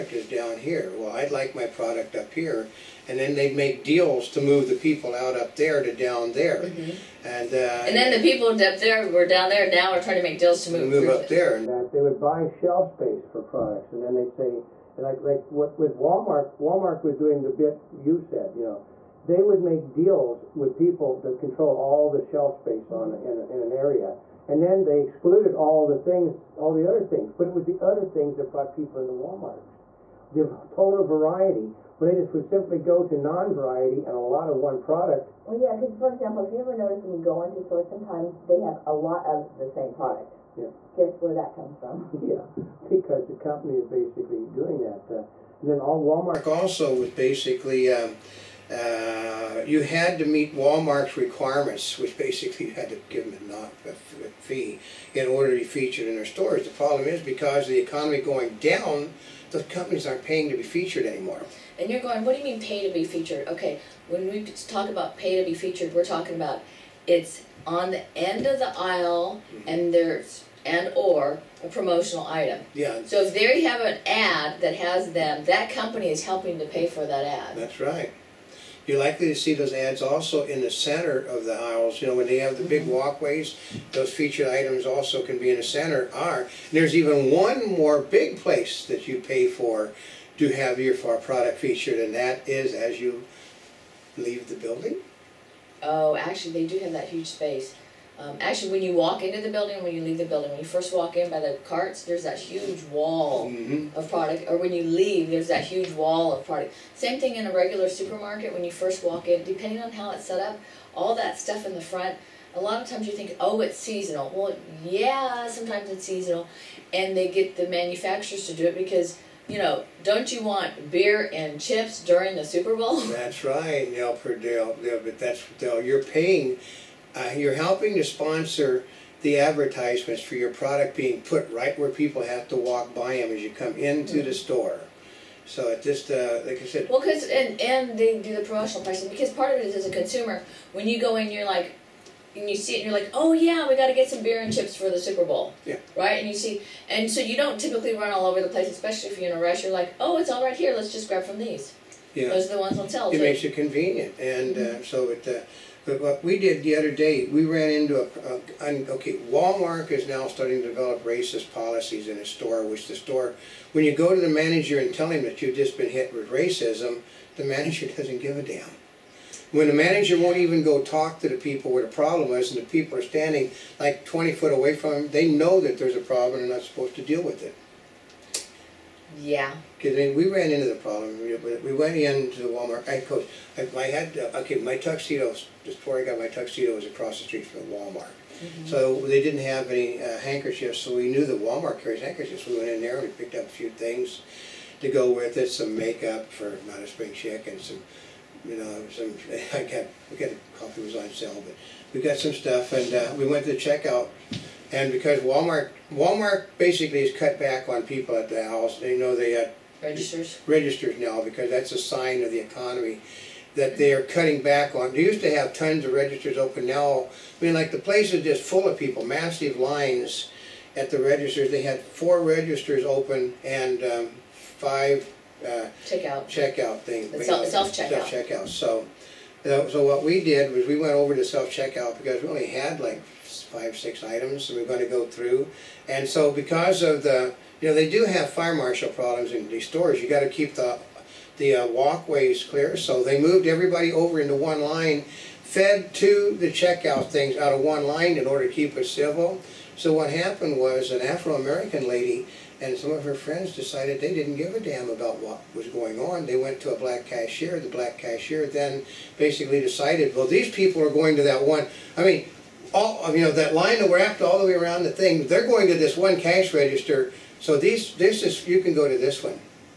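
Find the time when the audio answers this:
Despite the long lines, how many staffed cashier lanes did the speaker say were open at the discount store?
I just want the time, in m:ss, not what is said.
3:41.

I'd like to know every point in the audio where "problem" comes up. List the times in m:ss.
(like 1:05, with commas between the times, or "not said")
0:56, 2:51, 2:56, 3:00, 3:58.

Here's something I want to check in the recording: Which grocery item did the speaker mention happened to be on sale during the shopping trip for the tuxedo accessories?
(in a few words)
coffee.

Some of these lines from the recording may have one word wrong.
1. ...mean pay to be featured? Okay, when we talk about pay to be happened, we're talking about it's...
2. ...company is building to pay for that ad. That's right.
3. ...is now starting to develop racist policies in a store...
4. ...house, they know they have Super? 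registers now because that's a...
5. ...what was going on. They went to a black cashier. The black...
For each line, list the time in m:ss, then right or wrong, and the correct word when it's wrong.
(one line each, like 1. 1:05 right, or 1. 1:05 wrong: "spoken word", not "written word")
1. 1:02 wrong: "featured", not "happened"
2. 1:15 wrong: "helping", not "building"
3. 2:39 right
4. 3:28 wrong: "Registers", not "Super"
5. 4:15 right.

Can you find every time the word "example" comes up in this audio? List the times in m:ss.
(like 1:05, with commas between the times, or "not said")
0:36.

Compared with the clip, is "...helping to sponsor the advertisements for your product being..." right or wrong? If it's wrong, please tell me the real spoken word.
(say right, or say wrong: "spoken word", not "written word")
right.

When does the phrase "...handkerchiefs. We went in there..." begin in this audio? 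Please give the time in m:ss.
3:12.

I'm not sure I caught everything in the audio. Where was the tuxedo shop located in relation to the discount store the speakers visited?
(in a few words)
across the street.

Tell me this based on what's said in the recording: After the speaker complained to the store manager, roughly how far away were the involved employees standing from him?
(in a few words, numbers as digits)
20 feet.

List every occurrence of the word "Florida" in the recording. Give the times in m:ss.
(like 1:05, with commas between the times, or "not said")
not said.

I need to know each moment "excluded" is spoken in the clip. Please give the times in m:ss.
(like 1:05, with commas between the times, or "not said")
0:25.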